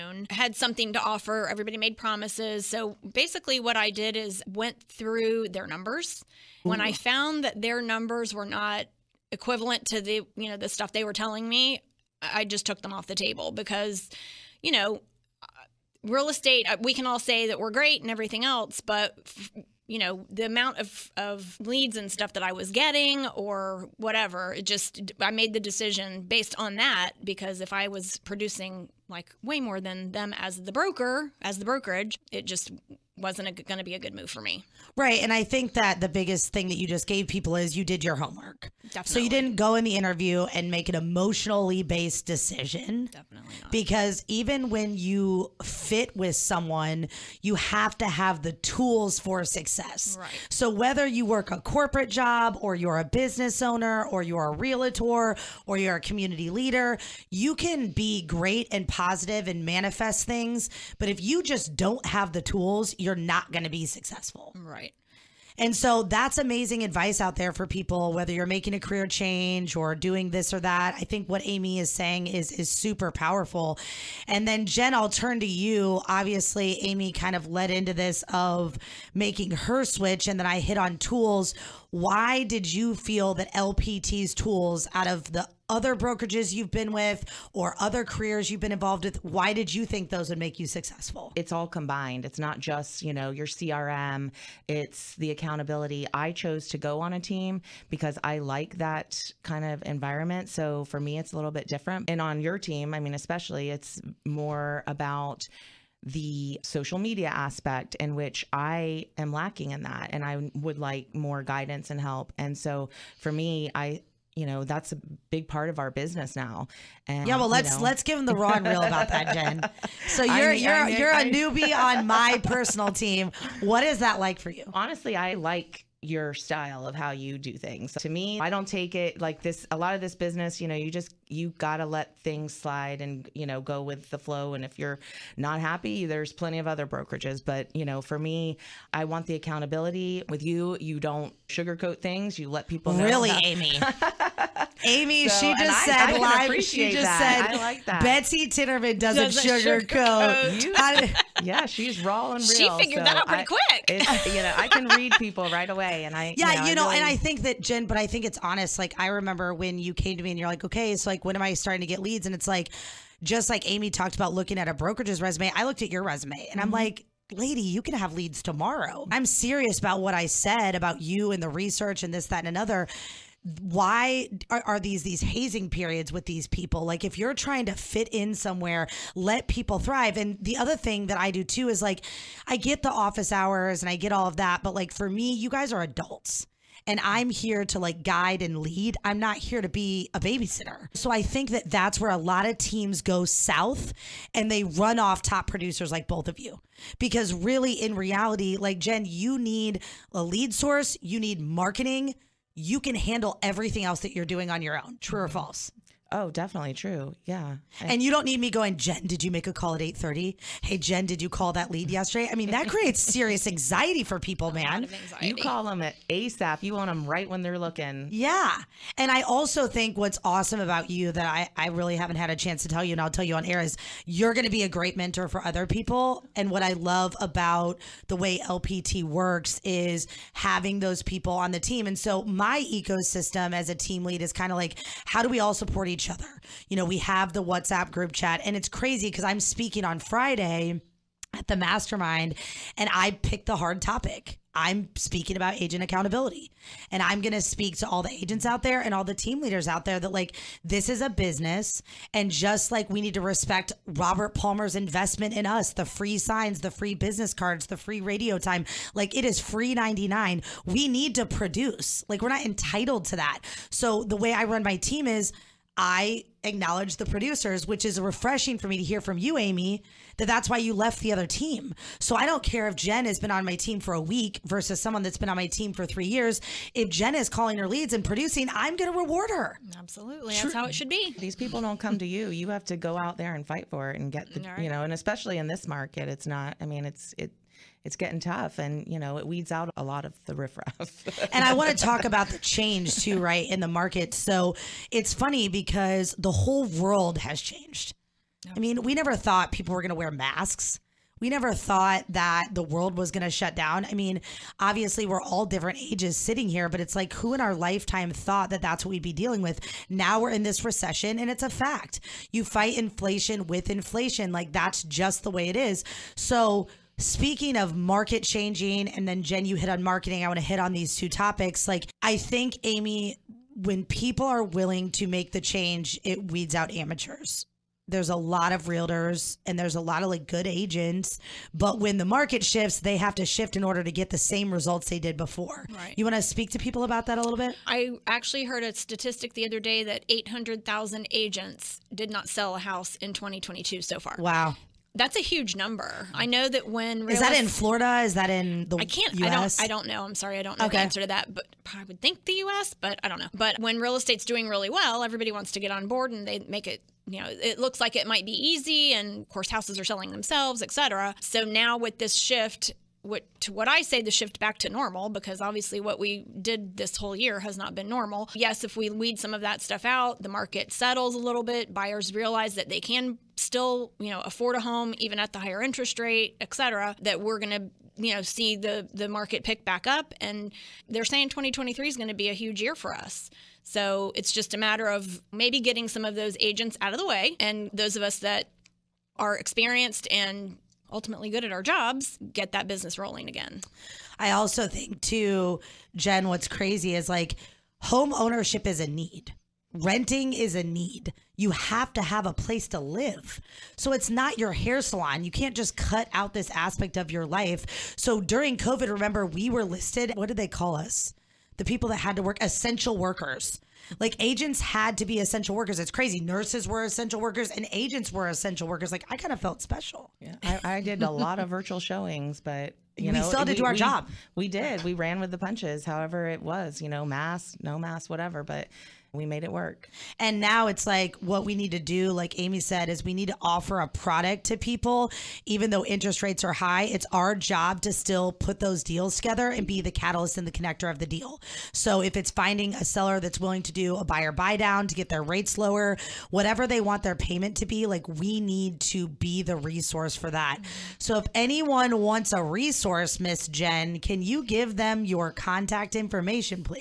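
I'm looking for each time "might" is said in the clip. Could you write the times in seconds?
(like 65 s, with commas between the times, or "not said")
358 s.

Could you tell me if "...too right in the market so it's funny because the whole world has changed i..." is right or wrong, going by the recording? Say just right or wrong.
right.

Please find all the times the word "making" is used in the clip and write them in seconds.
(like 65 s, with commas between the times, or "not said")
68 s, 79 s.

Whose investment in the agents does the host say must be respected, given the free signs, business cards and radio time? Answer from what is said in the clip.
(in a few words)
Robert Palmer.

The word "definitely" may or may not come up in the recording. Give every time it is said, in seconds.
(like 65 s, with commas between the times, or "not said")
38 s, 43 s, 206 s.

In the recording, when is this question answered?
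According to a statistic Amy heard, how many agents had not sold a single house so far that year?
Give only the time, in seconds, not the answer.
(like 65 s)
340 s.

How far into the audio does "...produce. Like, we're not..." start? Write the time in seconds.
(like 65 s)
261 s.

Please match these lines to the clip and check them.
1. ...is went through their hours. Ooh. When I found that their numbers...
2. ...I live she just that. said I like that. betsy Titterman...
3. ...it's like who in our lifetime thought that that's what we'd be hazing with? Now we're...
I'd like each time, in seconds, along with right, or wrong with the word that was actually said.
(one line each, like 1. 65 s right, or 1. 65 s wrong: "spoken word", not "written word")
1. 4 s wrong: "numbers", not "hours"
2. 146 s right
3. 306 s wrong: "dealing", not "hazing".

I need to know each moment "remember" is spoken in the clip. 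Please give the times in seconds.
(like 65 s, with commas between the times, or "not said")
159 s, 408 s.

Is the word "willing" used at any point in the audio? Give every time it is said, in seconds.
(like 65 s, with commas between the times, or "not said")
324 s, 443 s.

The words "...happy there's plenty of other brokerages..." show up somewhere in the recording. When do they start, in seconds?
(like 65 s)
135 s.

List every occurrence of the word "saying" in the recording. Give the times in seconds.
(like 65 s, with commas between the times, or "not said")
71 s, 381 s.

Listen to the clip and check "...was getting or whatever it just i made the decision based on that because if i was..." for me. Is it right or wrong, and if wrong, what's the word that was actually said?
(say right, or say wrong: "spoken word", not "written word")
right.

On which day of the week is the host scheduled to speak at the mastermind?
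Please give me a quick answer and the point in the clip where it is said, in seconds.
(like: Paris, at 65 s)
Friday, at 239 s.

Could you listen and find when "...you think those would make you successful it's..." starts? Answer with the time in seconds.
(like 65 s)
89 s.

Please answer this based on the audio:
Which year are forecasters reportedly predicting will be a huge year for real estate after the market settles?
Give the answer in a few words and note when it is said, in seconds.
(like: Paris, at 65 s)
2023, at 381 s.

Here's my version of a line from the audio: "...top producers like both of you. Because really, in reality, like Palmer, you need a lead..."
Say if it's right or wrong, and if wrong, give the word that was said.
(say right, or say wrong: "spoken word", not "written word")
wrong: "Jen", not "Palmer".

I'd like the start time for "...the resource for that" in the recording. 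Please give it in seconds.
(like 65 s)
449 s.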